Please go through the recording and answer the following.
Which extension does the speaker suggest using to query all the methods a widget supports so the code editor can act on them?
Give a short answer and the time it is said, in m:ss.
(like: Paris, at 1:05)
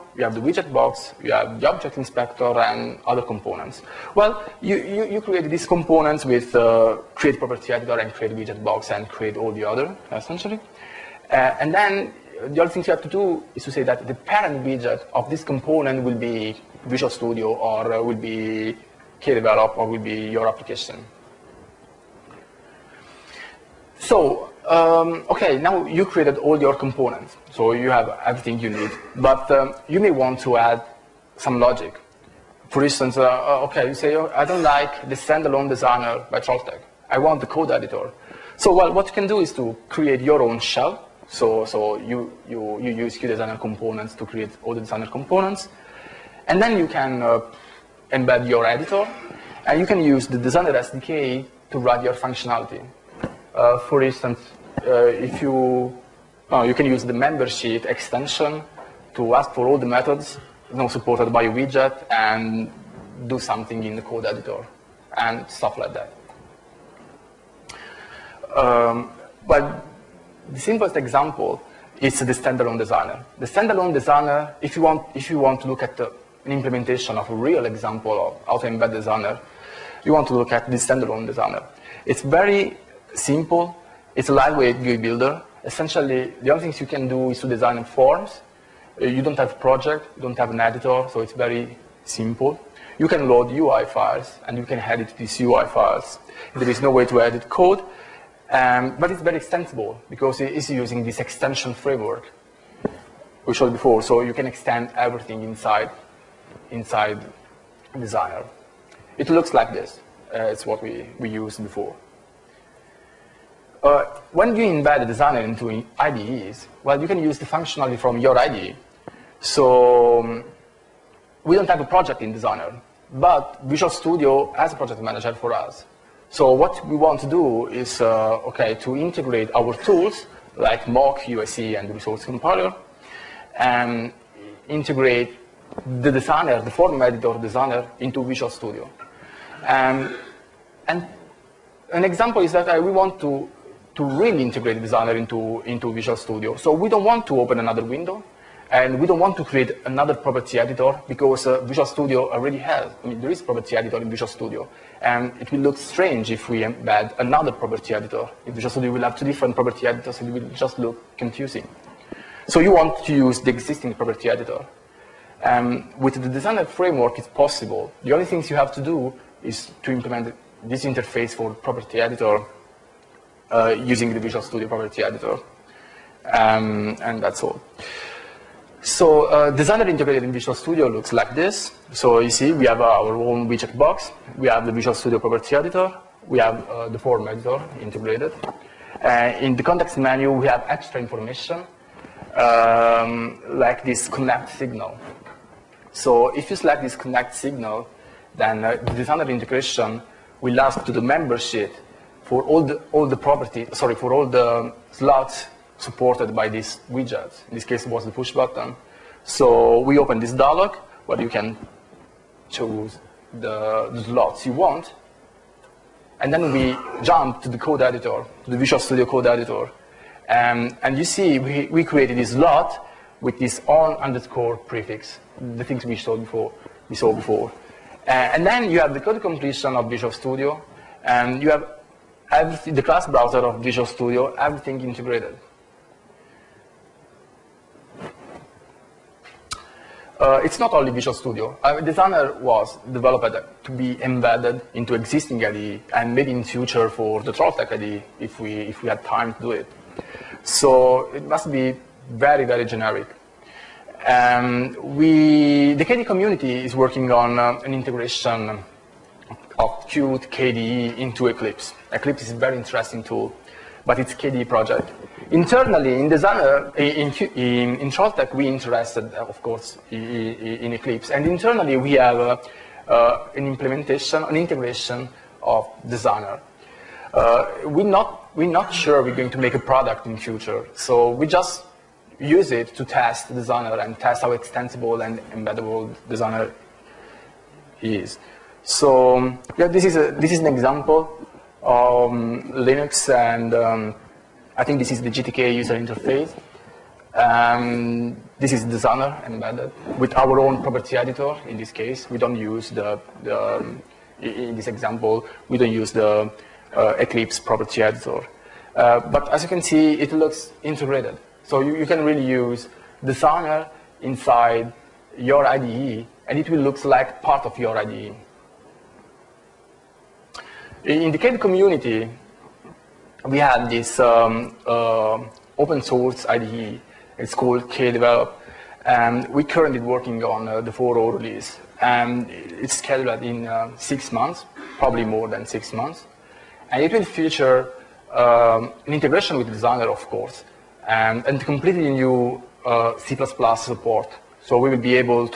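member sheet extension, at 0:57.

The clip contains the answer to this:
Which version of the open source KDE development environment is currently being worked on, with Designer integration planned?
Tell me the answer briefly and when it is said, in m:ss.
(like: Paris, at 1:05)
4.0, at 5:30.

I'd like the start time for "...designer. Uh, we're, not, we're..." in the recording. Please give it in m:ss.
4:35.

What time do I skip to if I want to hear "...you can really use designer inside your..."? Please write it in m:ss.
5:11.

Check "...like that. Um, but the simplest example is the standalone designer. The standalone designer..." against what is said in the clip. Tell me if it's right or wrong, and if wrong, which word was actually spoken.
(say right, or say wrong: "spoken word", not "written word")
right.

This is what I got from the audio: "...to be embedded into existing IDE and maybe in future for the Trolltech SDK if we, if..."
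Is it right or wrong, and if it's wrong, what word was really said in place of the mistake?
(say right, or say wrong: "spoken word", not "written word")
wrong: "IDE", not "SDK".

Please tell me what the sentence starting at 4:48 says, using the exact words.
So yeah, this is a, this is an example um, Linux, and um, I think this is the GTK user interface.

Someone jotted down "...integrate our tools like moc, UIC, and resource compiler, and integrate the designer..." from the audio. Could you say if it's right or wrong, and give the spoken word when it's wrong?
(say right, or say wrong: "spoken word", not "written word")
right.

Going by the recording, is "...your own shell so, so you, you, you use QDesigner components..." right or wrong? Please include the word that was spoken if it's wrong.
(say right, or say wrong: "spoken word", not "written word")
right.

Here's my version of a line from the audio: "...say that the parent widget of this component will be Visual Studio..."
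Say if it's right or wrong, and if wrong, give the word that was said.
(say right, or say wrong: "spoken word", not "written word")
right.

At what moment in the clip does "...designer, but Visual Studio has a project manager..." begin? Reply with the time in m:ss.
2:02.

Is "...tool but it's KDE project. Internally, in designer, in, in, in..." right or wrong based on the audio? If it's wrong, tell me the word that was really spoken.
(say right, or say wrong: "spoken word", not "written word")
right.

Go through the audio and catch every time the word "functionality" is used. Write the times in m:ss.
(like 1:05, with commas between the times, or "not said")
0:52, 1:57.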